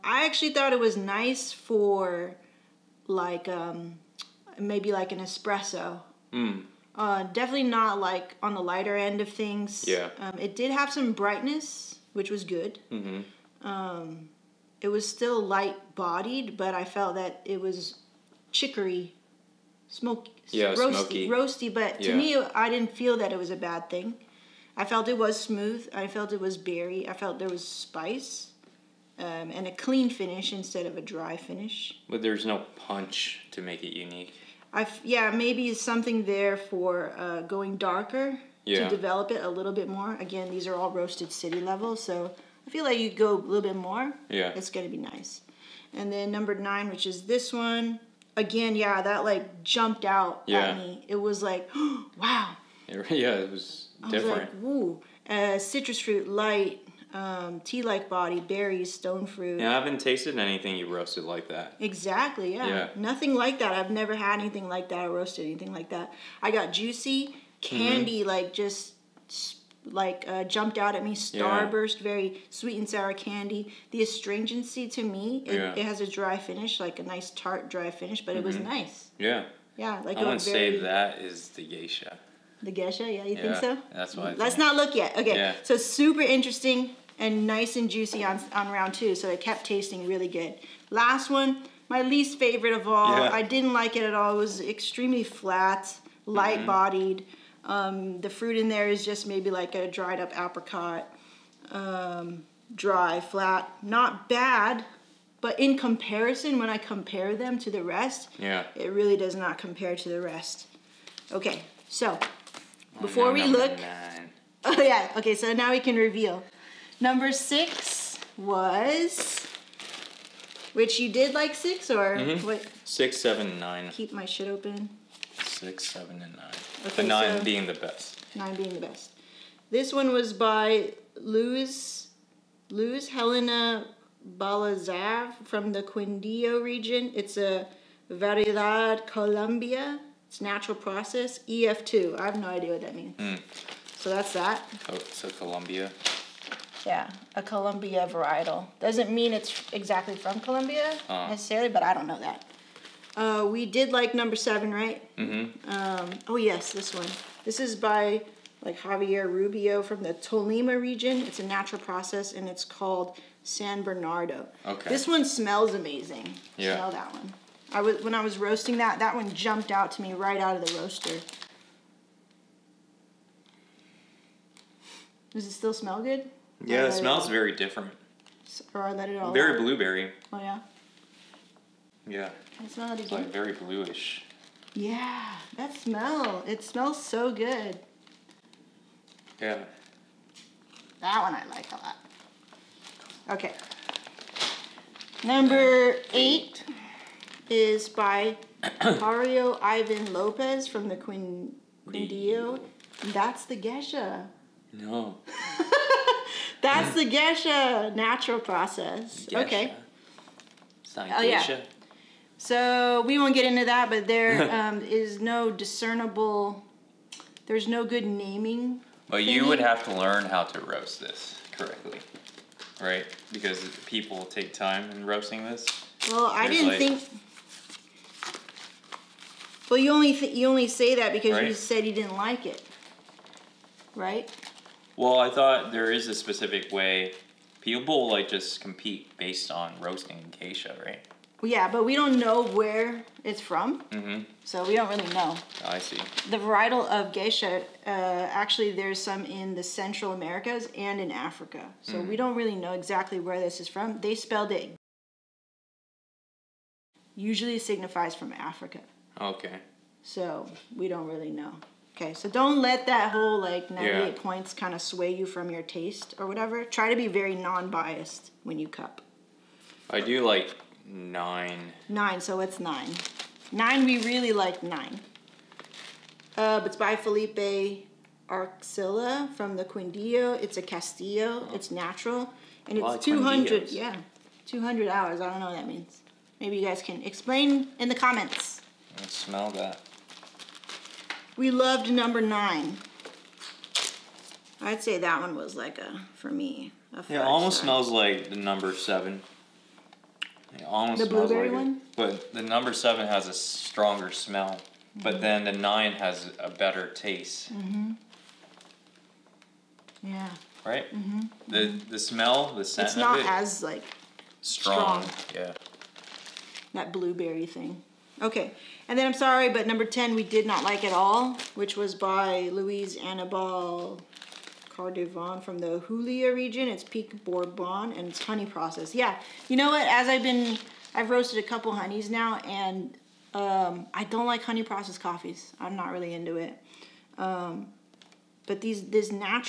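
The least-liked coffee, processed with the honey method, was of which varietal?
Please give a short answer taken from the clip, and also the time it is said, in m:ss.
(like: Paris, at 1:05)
Pink Bourbon, at 5:26.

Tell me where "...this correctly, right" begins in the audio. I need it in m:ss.
3:41.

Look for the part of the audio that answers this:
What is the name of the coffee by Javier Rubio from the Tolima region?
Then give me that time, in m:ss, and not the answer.
2:43.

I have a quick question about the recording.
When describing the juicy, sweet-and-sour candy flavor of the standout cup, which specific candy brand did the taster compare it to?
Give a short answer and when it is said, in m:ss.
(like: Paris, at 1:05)
Starburst, at 1:11.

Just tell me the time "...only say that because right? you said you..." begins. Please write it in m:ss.
3:50.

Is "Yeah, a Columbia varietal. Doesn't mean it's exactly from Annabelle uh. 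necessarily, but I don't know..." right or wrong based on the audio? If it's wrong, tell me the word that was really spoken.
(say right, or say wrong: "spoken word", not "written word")
wrong: "Columbia", not "Annabelle".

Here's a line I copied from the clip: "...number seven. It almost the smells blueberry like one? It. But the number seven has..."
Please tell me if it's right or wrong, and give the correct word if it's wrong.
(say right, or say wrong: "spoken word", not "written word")
right.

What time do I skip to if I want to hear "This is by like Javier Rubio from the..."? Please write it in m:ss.
2:37.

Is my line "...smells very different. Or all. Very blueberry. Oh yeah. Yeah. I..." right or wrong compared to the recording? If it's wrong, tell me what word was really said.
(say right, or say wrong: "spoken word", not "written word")
right.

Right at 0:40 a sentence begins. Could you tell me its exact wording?
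Again, these are all roasted city level, so I feel like you go a little bit more.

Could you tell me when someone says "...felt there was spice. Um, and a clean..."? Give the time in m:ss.
0:27.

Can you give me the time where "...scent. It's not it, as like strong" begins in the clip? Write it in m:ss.
5:12.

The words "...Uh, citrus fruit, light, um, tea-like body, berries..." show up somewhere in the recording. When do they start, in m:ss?
0:55.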